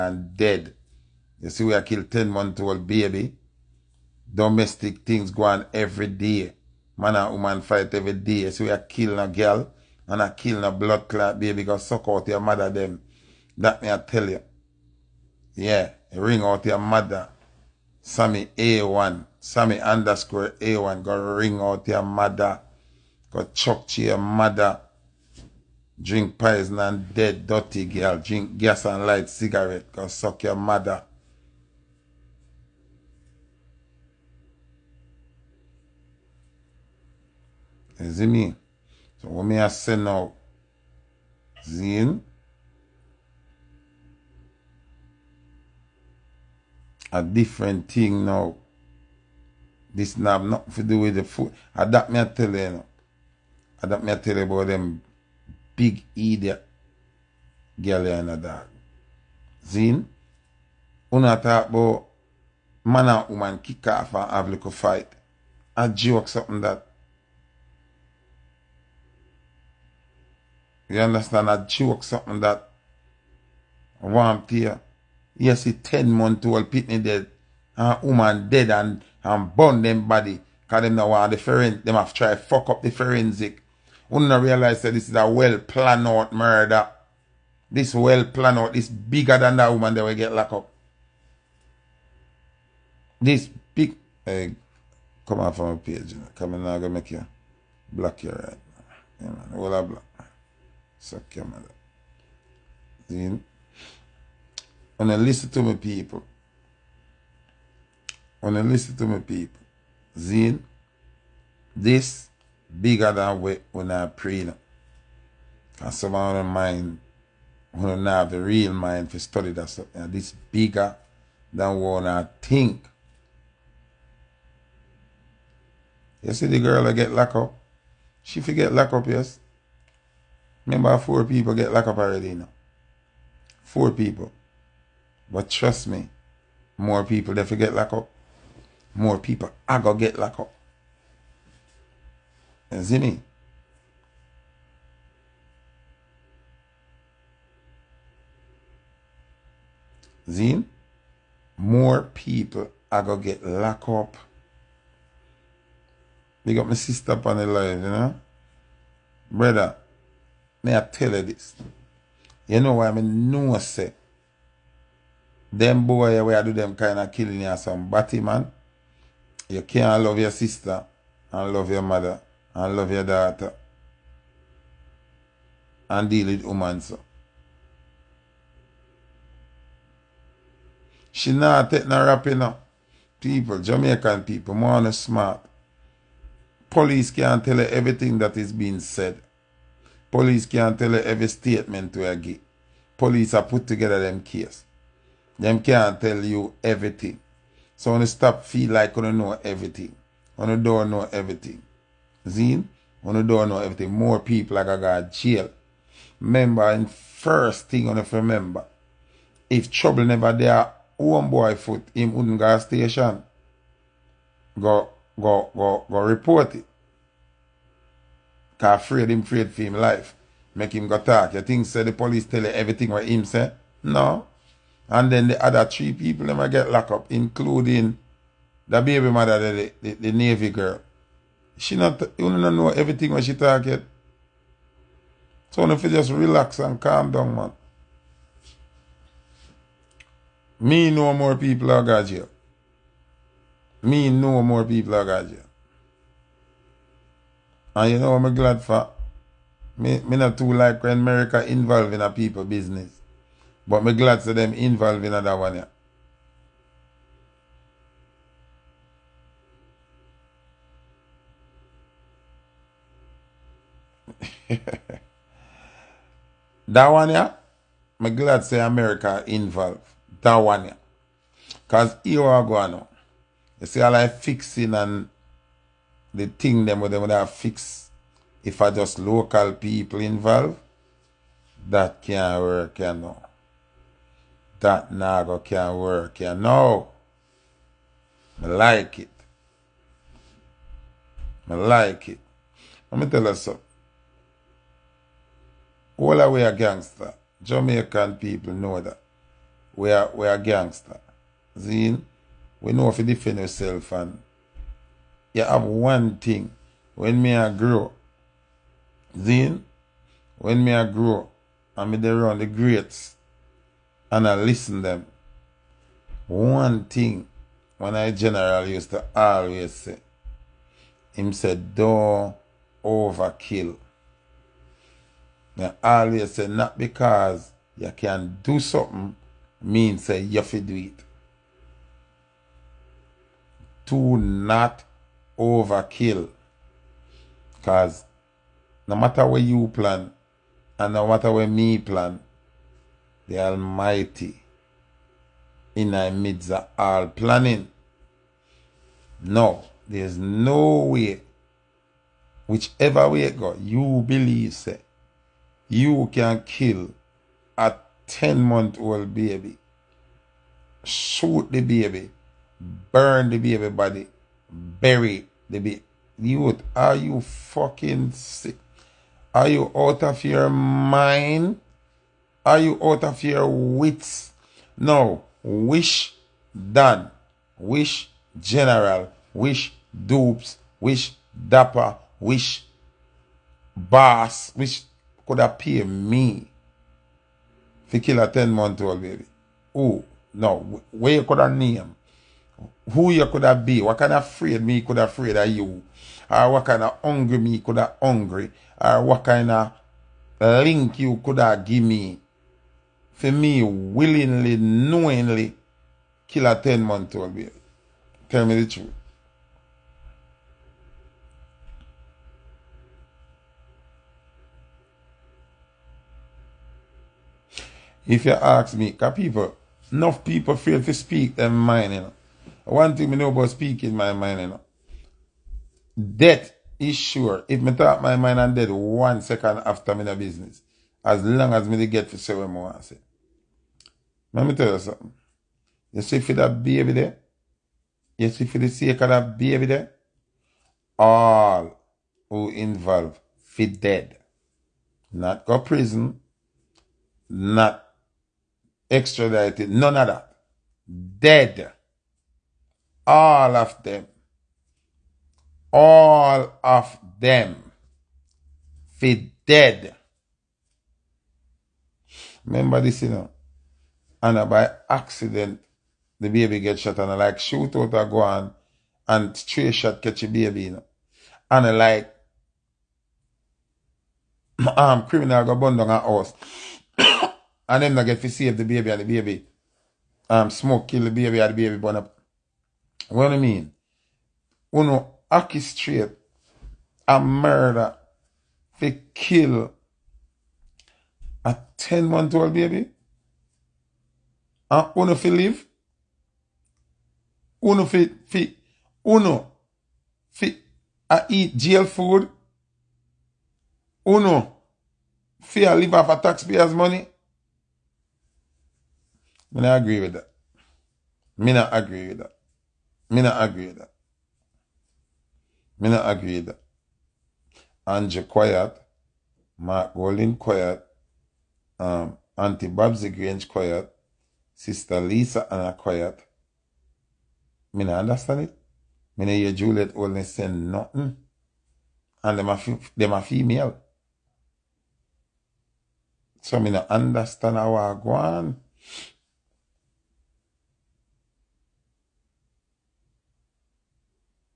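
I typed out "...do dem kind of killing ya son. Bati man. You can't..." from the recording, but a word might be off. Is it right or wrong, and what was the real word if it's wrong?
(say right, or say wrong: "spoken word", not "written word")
right.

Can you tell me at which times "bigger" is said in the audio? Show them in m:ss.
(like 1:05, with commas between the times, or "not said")
1:28, 1:52, 2:00.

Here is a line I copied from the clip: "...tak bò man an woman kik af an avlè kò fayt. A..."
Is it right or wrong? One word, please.
wrong.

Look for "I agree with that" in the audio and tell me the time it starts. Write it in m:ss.
8:29.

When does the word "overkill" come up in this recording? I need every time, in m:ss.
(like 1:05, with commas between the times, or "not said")
5:22, 5:35.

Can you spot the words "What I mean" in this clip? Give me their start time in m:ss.
8:03.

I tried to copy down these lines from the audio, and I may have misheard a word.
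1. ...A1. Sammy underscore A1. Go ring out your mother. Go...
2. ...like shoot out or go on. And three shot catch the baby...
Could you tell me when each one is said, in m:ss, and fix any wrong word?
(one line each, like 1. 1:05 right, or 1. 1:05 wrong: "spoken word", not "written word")
1. 0:18 right
2. 7:47 right.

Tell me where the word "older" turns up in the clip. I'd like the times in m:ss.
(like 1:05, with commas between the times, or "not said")
not said.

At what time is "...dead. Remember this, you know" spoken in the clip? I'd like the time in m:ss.
7:39.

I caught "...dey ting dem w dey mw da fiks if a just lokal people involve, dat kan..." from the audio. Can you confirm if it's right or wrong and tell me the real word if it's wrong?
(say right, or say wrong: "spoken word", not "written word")
right.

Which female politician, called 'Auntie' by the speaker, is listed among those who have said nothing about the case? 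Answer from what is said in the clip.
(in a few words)
Babsy Grange.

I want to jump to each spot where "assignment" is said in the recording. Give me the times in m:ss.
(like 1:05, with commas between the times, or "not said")
not said.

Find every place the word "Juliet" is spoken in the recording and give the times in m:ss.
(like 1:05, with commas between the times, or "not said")
8:49.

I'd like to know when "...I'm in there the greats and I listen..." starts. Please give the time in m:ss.
5:11.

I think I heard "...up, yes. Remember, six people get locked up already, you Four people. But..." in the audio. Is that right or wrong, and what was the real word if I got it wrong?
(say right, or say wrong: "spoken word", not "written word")
wrong: "four", not "six".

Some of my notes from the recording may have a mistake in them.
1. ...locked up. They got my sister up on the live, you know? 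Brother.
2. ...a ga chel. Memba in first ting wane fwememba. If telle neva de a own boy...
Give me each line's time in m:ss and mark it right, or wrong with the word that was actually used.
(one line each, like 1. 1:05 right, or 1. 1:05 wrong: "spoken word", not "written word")
1. 2:33 right
2. 3:24 wrong: "trouble", not "telle".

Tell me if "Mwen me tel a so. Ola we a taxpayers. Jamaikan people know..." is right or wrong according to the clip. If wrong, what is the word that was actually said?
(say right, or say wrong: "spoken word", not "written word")
wrong: "gangster", not "taxpayers".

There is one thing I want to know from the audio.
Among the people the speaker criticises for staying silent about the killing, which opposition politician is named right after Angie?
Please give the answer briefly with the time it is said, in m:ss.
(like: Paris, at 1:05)
Mark Golding, at 8:39.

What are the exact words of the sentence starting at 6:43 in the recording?
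For me, willingly, knowingly, kill a 10 month old baby.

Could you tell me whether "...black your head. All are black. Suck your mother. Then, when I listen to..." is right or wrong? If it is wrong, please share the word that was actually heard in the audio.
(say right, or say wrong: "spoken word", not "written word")
right.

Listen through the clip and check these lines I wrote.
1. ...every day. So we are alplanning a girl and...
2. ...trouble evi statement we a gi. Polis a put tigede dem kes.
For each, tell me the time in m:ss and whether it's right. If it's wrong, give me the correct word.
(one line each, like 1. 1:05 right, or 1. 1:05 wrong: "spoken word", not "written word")
1. 0:07 wrong: "killing", not "alplanning"
2. 3:10 wrong: "telle", not "trouble".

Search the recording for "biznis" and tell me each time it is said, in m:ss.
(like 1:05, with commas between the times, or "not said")
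4:12, 7:10.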